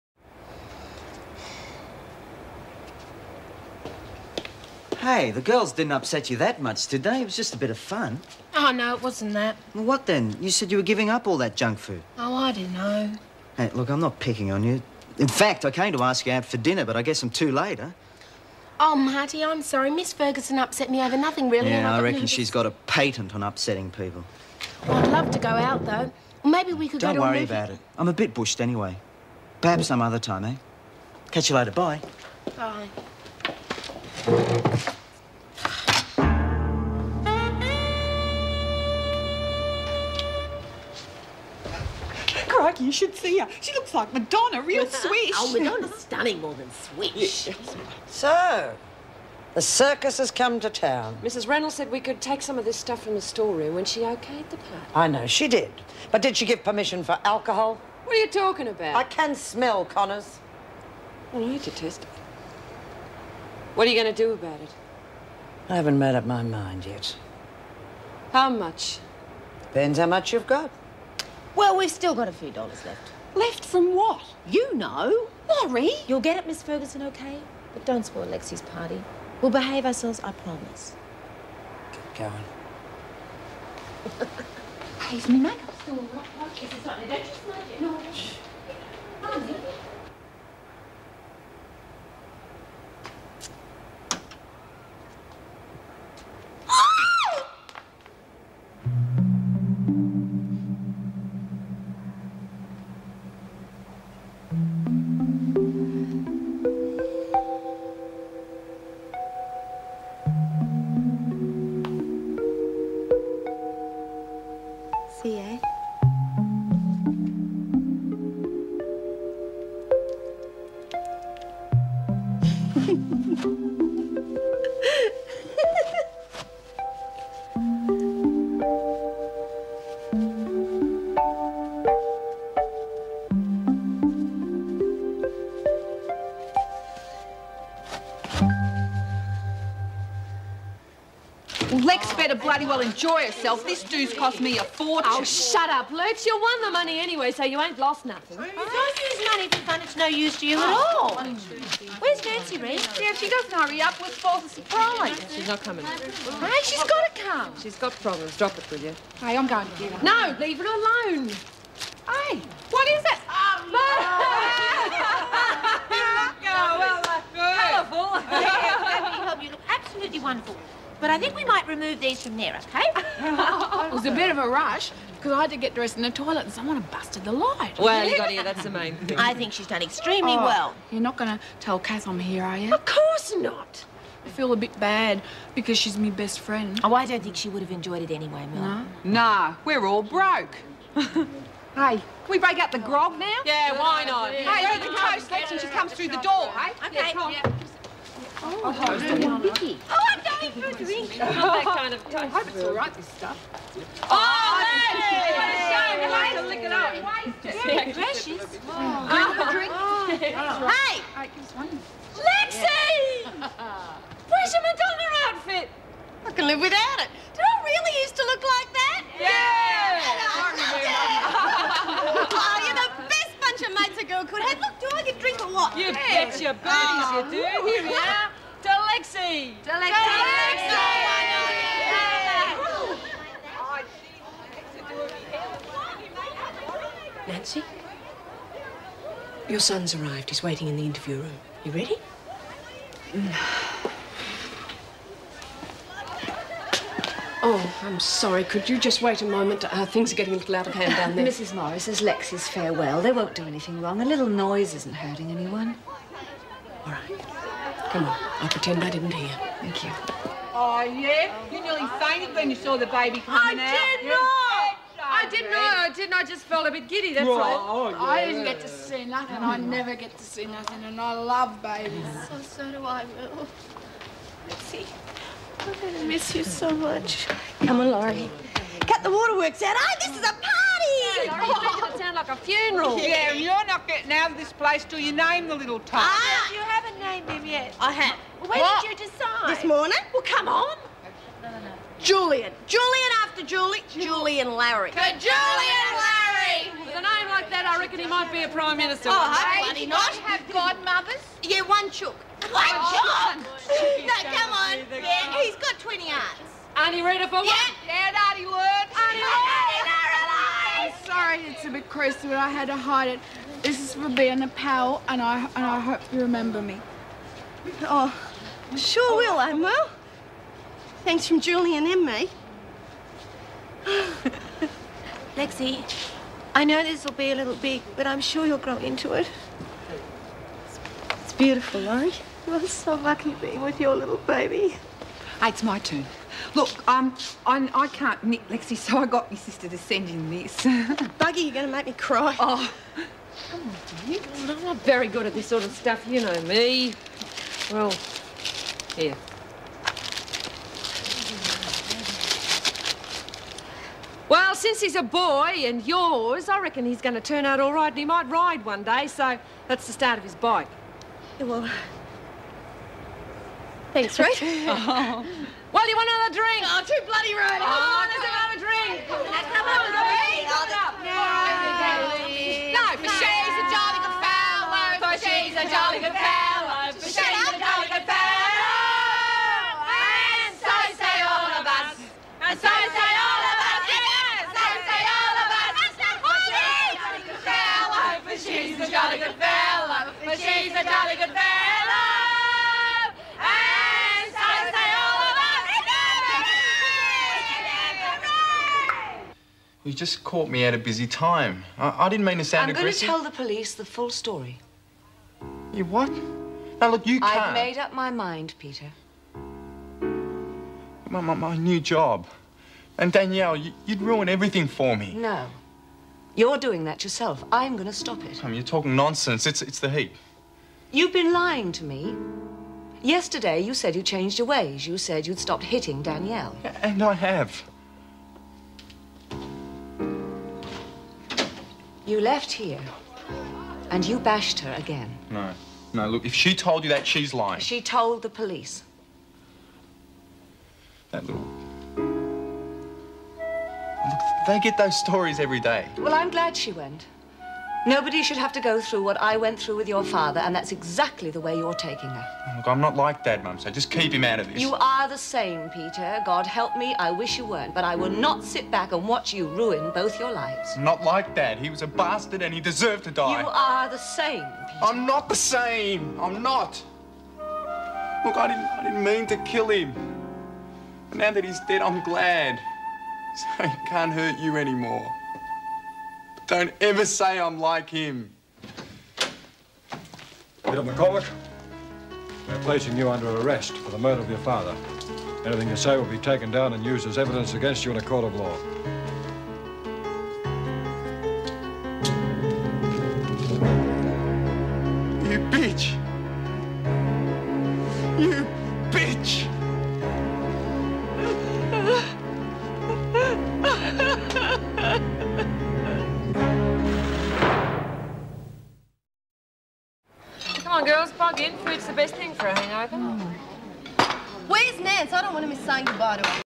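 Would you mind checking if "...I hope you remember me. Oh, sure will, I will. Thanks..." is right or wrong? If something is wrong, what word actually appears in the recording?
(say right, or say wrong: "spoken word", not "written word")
right.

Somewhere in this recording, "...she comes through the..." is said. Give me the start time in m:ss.
3:15.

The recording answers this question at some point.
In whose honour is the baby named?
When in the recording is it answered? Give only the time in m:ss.
4:53.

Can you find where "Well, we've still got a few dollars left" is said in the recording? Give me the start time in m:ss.
1:11.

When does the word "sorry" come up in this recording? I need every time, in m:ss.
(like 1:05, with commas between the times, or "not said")
0:19, 4:07, 5:11.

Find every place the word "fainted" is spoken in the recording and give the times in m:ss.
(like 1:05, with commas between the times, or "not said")
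4:21.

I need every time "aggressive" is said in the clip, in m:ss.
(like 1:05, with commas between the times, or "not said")
6:42.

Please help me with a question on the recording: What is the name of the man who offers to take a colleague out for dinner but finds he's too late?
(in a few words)
Marty.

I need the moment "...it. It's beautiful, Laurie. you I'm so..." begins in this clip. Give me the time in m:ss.
5:29.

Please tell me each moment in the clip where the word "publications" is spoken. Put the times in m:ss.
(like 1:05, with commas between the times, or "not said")
not said.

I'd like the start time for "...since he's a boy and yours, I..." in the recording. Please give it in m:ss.
5:54.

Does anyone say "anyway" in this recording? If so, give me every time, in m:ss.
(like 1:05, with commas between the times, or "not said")
0:28, 2:27, 3:08.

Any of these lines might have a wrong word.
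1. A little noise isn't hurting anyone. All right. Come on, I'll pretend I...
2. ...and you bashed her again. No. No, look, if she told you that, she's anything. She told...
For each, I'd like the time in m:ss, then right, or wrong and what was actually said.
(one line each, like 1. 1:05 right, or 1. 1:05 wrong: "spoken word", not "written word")
1. 4:14 right
2. 7:13 wrong: "lying", not "anything".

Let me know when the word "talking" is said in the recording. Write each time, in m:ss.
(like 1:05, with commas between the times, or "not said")
0:58, 6:58.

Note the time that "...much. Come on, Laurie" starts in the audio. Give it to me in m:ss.
4:36.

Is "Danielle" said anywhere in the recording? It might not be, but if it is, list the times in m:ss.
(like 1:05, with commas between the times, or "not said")
6:53, 7:06.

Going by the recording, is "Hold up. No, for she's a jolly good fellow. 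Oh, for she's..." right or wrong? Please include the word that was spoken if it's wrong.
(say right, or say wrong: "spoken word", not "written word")
right.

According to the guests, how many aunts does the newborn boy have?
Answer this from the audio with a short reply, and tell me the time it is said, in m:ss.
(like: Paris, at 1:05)
20, at 5:05.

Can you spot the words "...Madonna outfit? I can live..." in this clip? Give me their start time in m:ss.
3:34.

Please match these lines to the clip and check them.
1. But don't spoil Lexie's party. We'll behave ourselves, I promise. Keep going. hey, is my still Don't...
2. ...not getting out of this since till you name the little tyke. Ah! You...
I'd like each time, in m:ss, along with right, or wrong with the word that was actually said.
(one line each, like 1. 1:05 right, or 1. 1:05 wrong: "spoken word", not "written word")
1. 1:17 right
2. 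4:43 wrong: "place", not "since".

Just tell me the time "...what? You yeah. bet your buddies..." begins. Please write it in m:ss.
3:45.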